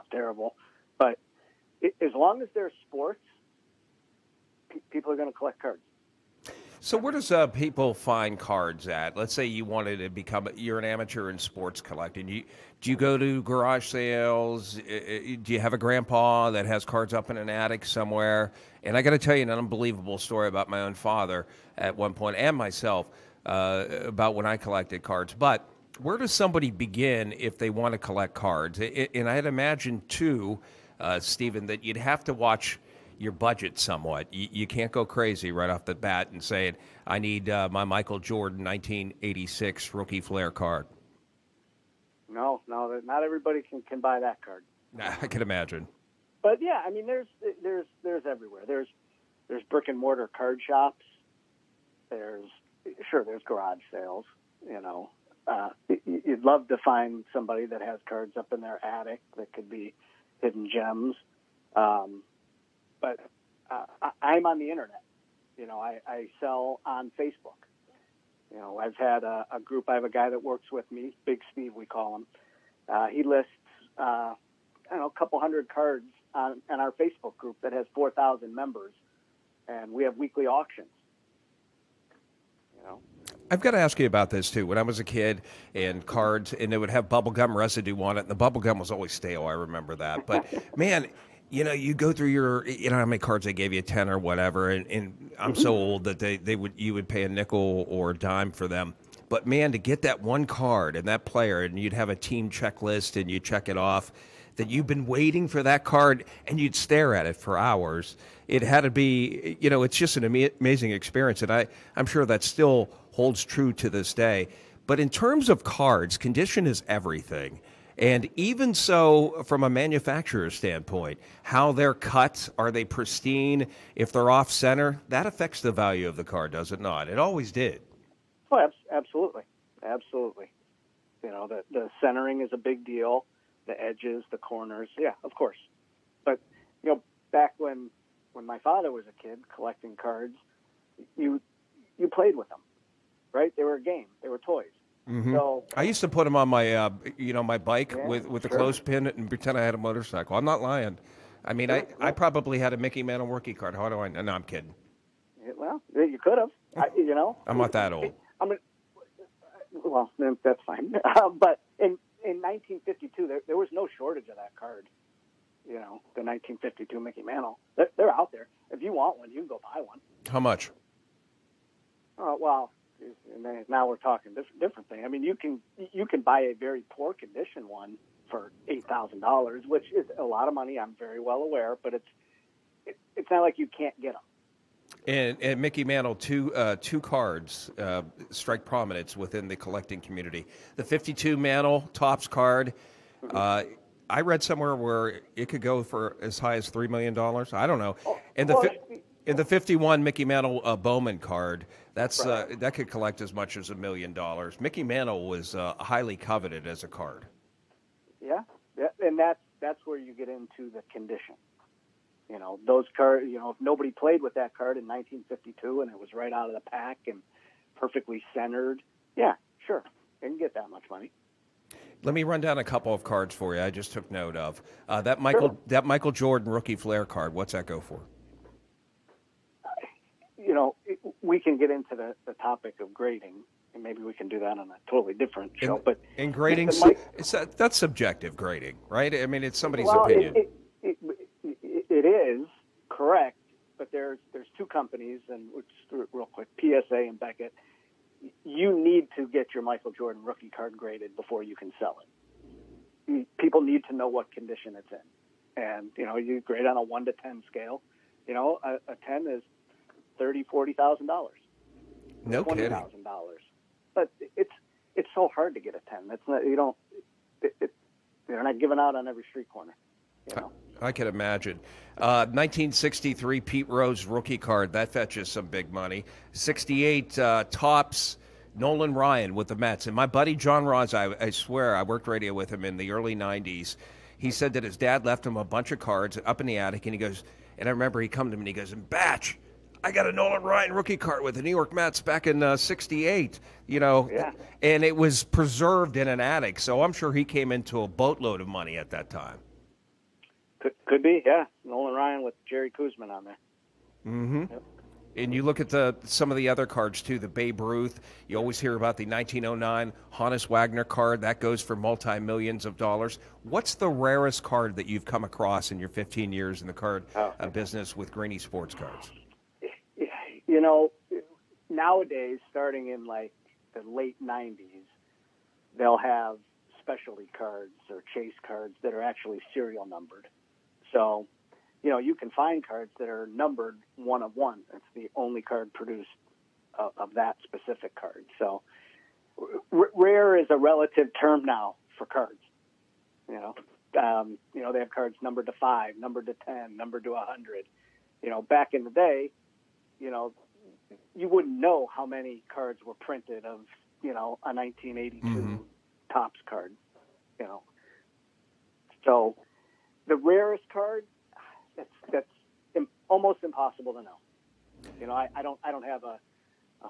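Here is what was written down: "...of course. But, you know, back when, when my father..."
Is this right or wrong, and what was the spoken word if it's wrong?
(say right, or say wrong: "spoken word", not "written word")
right.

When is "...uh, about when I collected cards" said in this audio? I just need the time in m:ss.
0:23.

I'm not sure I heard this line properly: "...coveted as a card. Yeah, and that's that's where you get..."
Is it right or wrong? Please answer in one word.
right.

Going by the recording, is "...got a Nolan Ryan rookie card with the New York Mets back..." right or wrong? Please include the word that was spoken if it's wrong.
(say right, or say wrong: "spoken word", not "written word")
right.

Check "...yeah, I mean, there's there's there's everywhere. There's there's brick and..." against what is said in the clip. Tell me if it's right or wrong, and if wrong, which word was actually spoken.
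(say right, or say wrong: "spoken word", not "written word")
right.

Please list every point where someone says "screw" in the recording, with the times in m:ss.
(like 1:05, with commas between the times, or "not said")
not said.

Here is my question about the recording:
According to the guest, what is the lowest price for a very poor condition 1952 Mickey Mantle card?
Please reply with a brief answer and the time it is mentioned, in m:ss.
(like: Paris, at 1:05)
$8,000, at 2:58.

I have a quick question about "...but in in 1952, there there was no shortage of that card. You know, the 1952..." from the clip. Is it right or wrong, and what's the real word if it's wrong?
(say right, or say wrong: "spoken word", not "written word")
right.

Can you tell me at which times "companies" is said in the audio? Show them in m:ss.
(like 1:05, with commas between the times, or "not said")
4:04.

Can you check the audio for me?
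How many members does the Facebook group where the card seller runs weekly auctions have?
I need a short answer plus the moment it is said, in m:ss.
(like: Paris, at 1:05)
4,000, at 1:17.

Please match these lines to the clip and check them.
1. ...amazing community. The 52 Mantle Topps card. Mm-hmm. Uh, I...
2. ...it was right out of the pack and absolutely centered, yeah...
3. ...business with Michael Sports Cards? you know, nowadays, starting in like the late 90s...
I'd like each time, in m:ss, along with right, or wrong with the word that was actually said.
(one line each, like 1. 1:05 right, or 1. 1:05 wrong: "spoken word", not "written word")
1. 3:09 wrong: "collecting", not "amazing"
2. 3:35 wrong: "perfectly", not "absolutely"
3. 5:17 wrong: "Greenies", not "Michael".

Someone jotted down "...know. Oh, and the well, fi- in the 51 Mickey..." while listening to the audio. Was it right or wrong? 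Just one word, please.
right.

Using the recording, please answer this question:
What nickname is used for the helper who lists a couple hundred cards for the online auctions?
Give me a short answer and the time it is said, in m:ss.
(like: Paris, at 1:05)
Big Steve, at 1:11.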